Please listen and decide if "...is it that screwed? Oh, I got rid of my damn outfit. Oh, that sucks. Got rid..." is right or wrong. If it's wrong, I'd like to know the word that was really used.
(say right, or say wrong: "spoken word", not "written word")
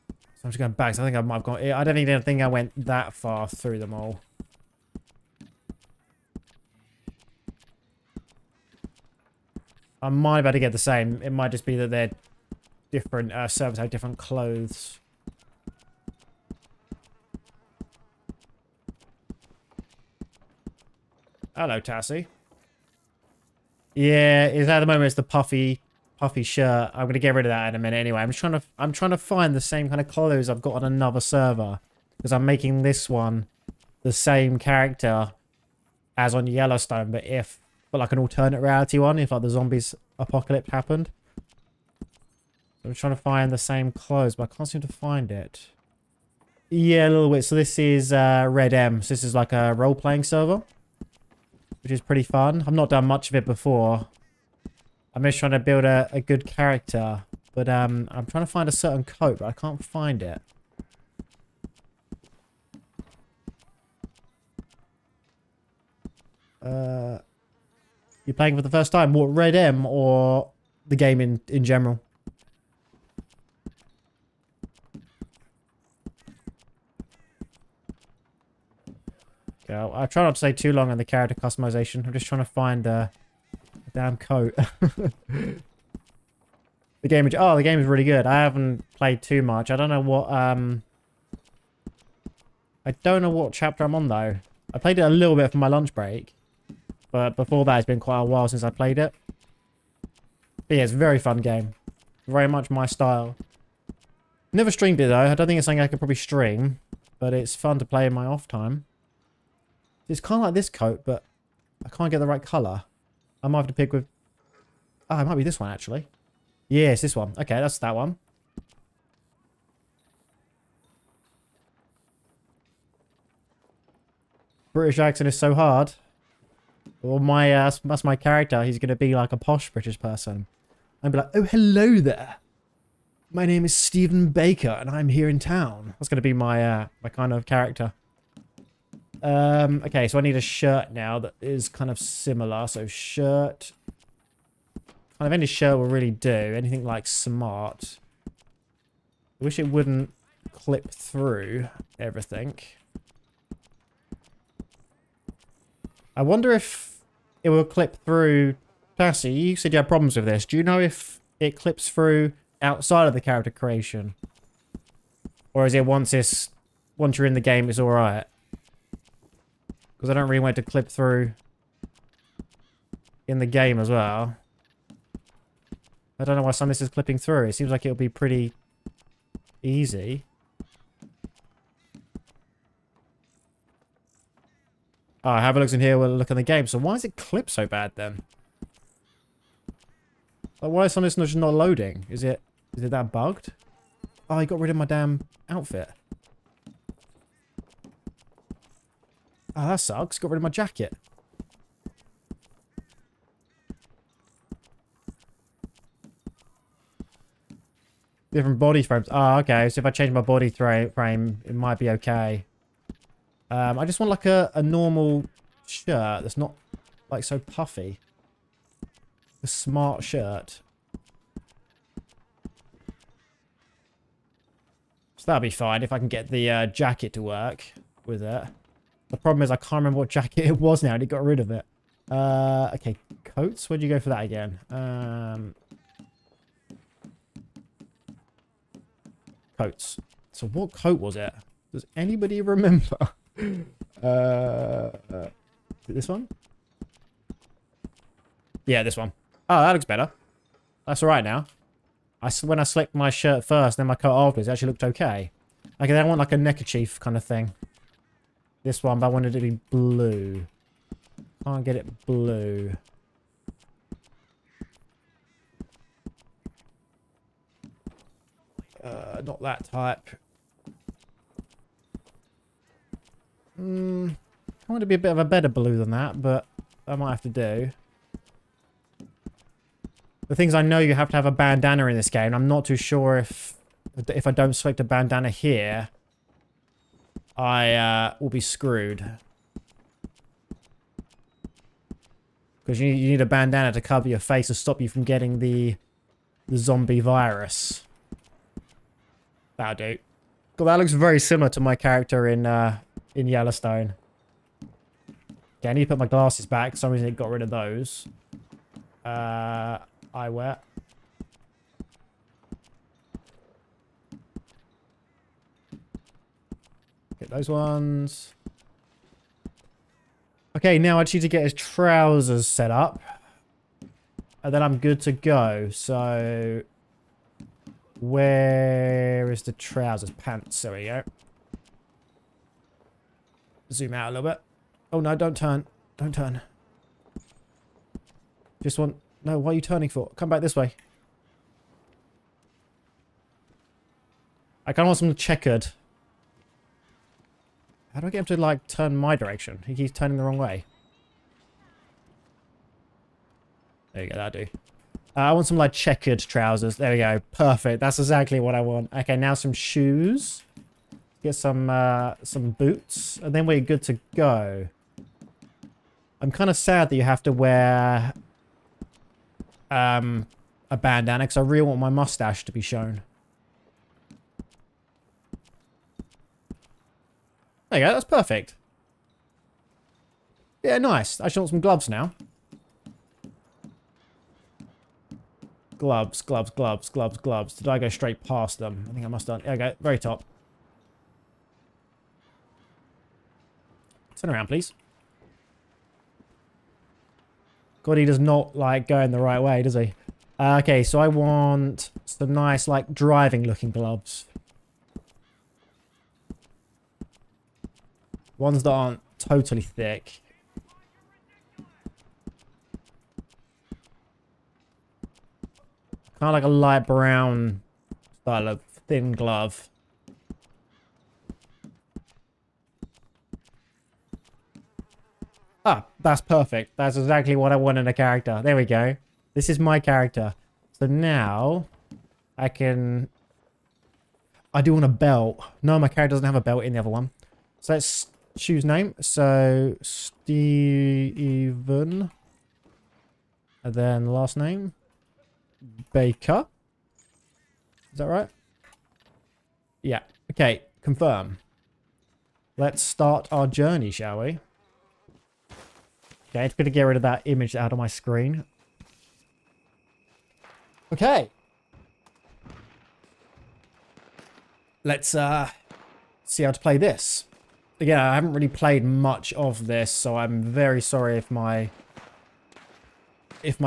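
wrong: "bugged", not "screwed".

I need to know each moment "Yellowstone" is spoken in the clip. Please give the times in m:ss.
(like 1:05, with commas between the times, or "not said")
0:36, 5:03.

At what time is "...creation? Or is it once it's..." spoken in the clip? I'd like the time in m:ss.
2:43.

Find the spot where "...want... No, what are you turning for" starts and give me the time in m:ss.
5:38.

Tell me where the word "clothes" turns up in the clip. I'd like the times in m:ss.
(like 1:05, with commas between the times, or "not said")
0:14, 0:30, 0:43.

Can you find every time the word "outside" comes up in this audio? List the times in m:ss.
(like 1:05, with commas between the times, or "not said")
2:42.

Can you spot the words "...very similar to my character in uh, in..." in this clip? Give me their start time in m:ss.
5:00.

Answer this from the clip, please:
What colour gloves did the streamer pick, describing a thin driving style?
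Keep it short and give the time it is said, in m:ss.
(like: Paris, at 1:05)
light brown, at 6:56.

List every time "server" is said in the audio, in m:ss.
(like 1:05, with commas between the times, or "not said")
0:13, 0:31, 0:50.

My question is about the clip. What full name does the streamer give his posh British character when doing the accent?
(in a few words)
Stephen Baker.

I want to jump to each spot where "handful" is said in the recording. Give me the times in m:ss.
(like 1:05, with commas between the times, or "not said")
not said.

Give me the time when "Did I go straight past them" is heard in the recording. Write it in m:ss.
6:27.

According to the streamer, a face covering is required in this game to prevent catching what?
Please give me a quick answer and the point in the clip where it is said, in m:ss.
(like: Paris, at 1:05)
the zombie virus, at 4:56.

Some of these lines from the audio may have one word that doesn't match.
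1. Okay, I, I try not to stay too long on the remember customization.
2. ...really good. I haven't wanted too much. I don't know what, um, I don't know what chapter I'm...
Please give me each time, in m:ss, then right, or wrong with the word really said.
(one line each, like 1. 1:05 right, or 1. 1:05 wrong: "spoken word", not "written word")
1. 1:19 wrong: "character", not "remember"
2. 1:27 wrong: "played", not "wanted".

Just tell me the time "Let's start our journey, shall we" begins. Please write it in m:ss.
7:32.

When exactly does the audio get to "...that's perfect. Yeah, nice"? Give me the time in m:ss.
6:17.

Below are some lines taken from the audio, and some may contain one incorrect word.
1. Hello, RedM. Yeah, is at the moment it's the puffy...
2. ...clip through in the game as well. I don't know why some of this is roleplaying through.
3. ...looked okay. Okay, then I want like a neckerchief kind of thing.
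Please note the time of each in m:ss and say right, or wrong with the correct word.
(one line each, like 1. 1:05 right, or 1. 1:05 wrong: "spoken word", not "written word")
1. 0:21 wrong: "Tassie", not "RedM"
2. 2:50 wrong: "clipping", not "roleplaying"
3. 4:14 right.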